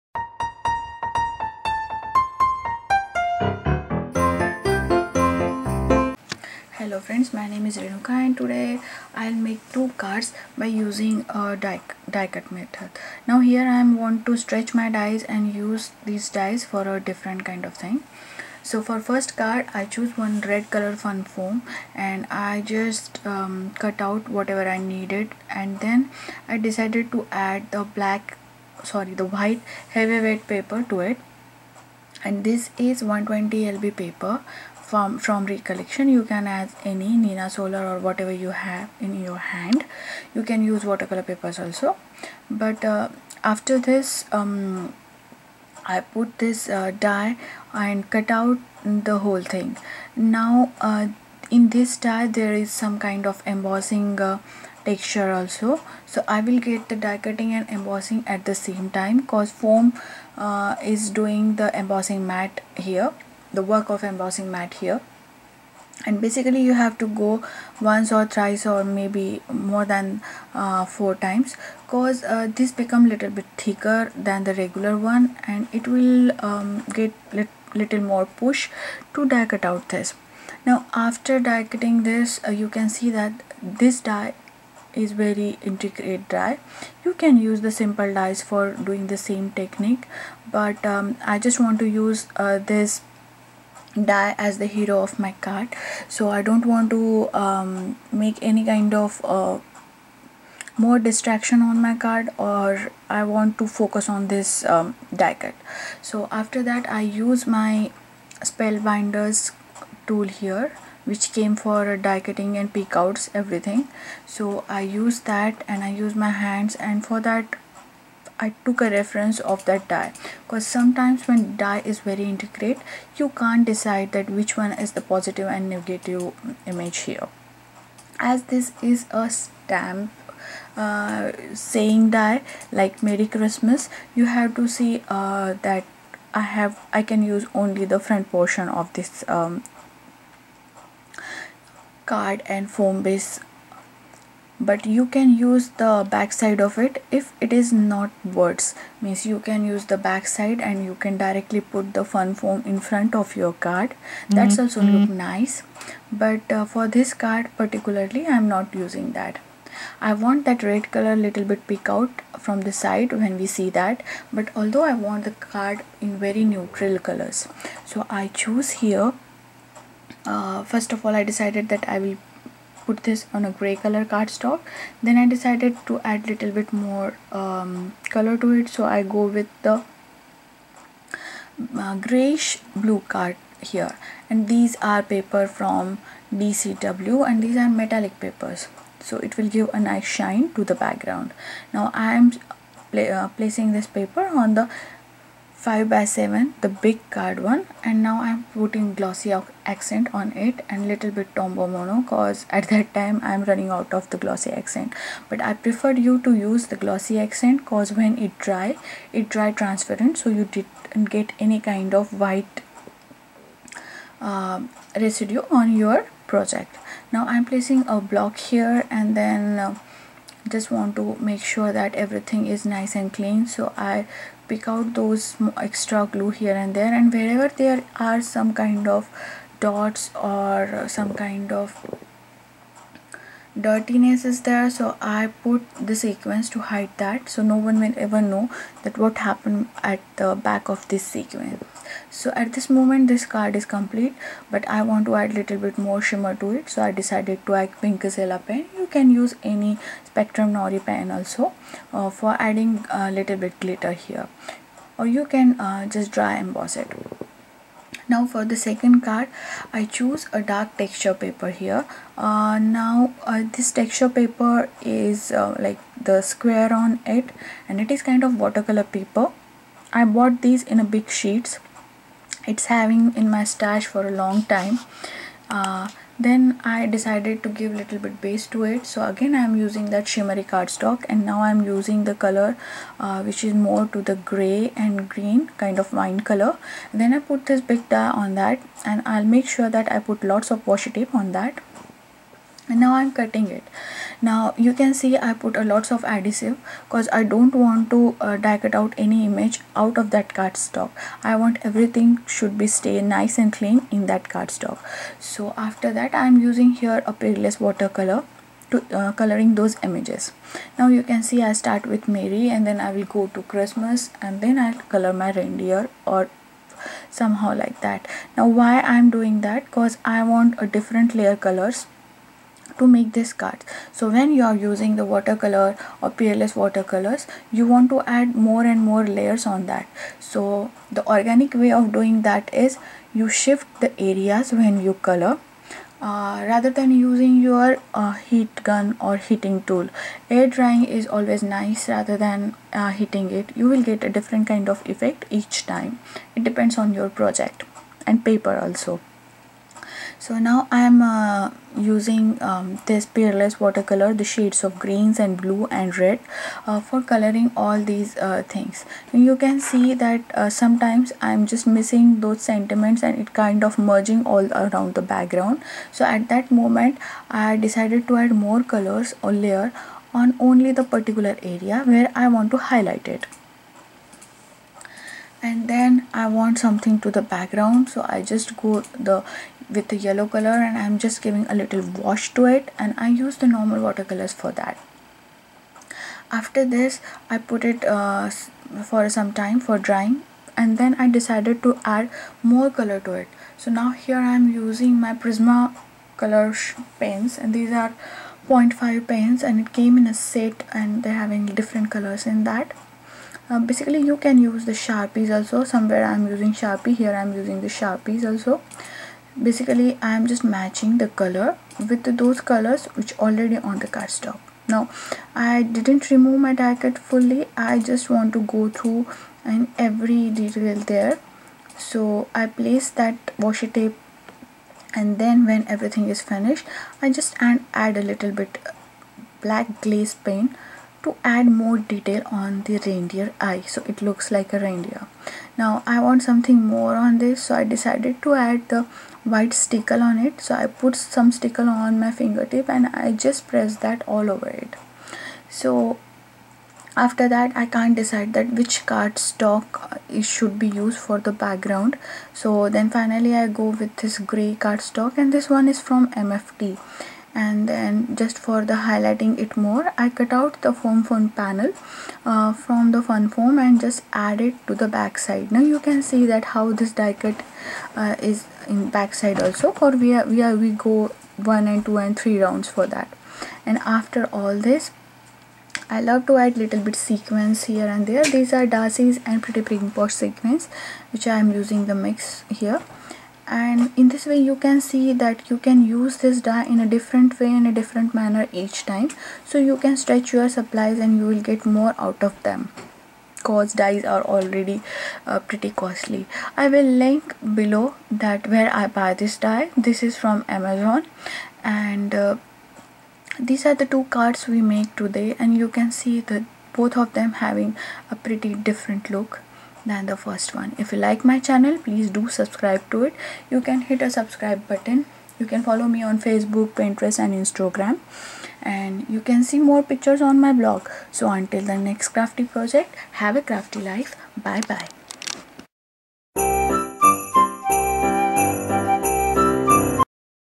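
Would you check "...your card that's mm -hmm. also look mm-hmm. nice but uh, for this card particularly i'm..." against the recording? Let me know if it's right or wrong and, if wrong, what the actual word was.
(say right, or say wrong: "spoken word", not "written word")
right.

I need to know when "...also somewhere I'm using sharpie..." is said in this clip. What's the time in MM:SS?
06:45.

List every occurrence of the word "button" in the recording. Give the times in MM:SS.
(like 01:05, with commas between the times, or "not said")
08:34.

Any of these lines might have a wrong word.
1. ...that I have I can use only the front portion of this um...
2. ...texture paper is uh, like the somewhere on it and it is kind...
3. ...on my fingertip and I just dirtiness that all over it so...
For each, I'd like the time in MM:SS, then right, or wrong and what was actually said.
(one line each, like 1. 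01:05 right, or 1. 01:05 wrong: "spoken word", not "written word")
1. 02:15 right
2. 04:23 wrong: "square", not "somewhere"
3. 07:21 wrong: "press", not "dirtiness".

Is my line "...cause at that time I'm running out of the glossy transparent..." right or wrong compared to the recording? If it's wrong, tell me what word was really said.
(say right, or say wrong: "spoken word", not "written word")
wrong: "accent", not "transparent".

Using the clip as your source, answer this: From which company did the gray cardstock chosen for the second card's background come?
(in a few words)
MFT.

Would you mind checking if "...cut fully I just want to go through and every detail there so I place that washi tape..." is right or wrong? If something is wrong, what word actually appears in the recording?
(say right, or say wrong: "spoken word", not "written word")
right.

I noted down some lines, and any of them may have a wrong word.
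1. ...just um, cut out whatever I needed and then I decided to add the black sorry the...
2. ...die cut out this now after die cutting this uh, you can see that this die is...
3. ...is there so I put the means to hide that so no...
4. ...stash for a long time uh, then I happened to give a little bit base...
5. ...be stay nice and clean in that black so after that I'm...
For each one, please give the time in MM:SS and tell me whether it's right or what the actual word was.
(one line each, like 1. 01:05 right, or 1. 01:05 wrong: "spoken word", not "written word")
1. 00:22 right
2. 01:19 right
3. 03:54 wrong: "sequins", not "means"
4. 04:33 wrong: "decided", not "happened"
5. 05:02 wrong: "cardstock", not "black".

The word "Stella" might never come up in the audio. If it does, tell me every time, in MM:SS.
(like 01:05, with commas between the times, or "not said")
04:08.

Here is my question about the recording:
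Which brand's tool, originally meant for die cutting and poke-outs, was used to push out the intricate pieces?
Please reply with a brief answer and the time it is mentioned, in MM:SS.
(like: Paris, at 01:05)
Spellbinders, at 01:48.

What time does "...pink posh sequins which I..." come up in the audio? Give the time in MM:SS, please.
07:59.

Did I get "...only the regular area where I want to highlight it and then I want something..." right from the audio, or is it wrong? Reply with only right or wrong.
wrong.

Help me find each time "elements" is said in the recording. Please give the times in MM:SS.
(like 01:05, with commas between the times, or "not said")
not said.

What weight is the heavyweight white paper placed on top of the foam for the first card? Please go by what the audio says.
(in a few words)
120 lb.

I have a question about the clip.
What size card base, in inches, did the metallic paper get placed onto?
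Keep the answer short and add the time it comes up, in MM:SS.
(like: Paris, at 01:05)
5 by 7, at 03:15.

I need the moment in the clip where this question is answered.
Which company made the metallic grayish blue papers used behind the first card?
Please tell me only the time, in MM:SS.
03:06.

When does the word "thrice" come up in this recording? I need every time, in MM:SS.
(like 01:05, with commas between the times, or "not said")
01:08.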